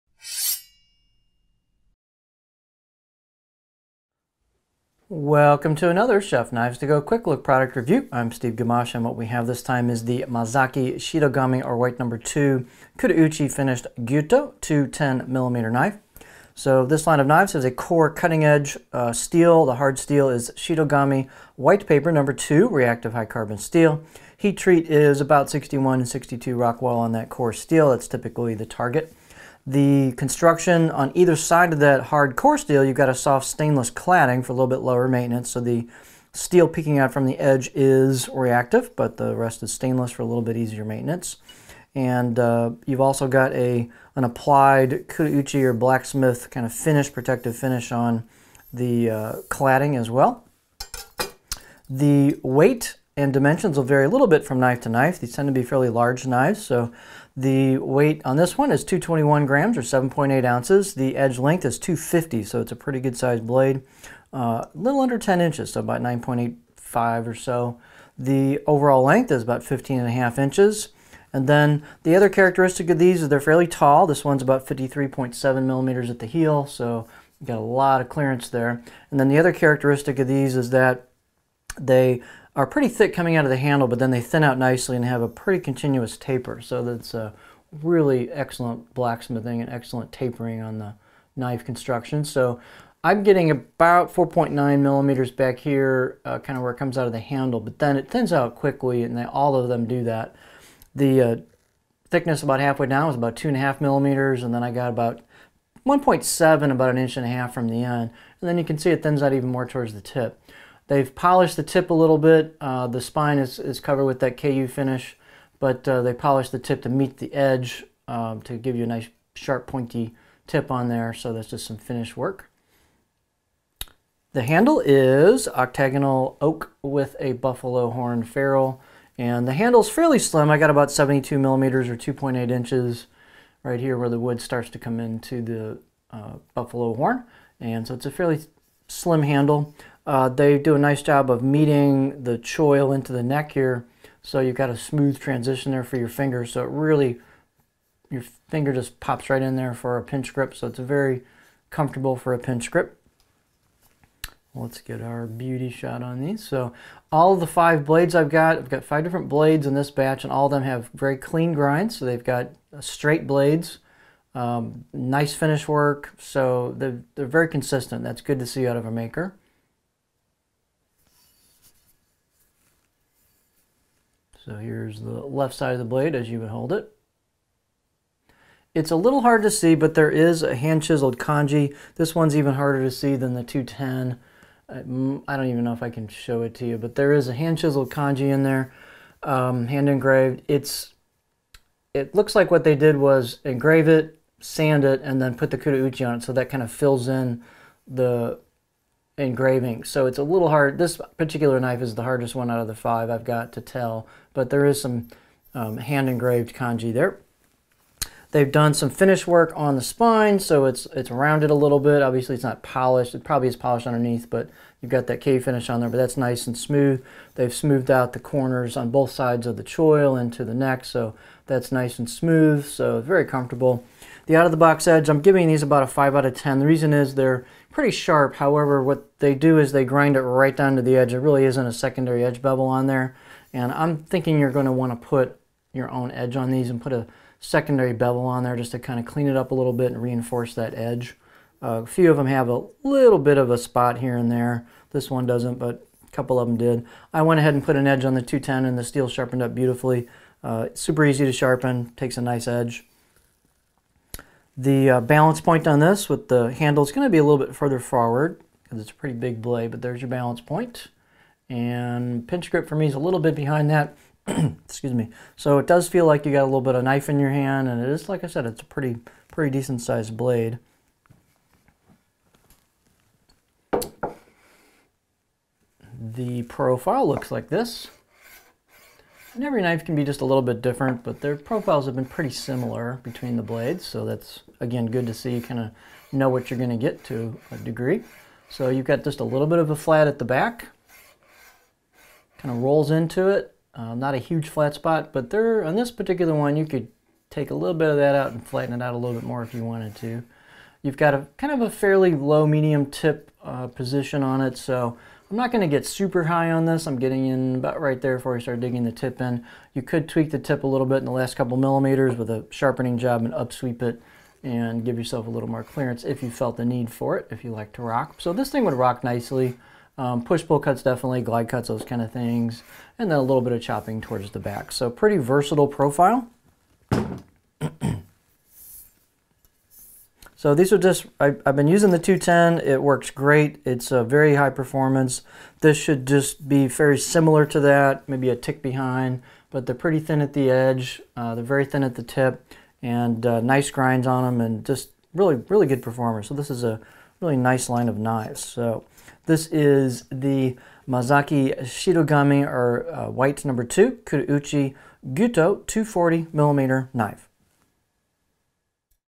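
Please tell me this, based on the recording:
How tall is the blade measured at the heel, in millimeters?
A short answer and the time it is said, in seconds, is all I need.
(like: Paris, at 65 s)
53.7 millimeters, at 74 s.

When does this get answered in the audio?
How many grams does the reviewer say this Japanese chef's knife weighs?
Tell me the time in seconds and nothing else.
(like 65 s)
58 s.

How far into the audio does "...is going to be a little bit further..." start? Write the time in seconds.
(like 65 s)
256 s.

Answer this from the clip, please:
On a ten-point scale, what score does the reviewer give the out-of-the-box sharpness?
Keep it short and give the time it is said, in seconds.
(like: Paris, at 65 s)
5 out of 10, at 225 s.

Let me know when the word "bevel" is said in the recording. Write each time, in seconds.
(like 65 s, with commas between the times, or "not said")
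232 s, 237 s.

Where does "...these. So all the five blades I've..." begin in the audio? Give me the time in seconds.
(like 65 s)
156 s.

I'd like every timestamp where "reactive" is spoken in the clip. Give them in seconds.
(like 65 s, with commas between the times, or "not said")
22 s, 38 s.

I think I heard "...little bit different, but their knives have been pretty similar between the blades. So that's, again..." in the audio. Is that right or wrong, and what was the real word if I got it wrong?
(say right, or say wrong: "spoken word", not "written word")
wrong: "profiles", not "knives".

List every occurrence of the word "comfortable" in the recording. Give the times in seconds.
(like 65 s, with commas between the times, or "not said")
151 s, 223 s.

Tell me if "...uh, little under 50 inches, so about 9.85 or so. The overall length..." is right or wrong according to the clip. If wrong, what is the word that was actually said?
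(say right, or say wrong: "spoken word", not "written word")
wrong: "10", not "50".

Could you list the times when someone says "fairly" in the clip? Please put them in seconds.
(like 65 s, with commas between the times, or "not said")
55 s, 73 s, 129 s, 138 s, 301 s.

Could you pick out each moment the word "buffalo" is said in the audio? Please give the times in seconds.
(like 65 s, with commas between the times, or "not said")
127 s, 136 s.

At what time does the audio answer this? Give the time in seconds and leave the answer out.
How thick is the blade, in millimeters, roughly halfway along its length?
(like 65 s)
103 s.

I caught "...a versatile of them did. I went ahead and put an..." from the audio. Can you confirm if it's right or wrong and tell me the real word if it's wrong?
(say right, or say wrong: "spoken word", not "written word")
wrong: "couple", not "versatile".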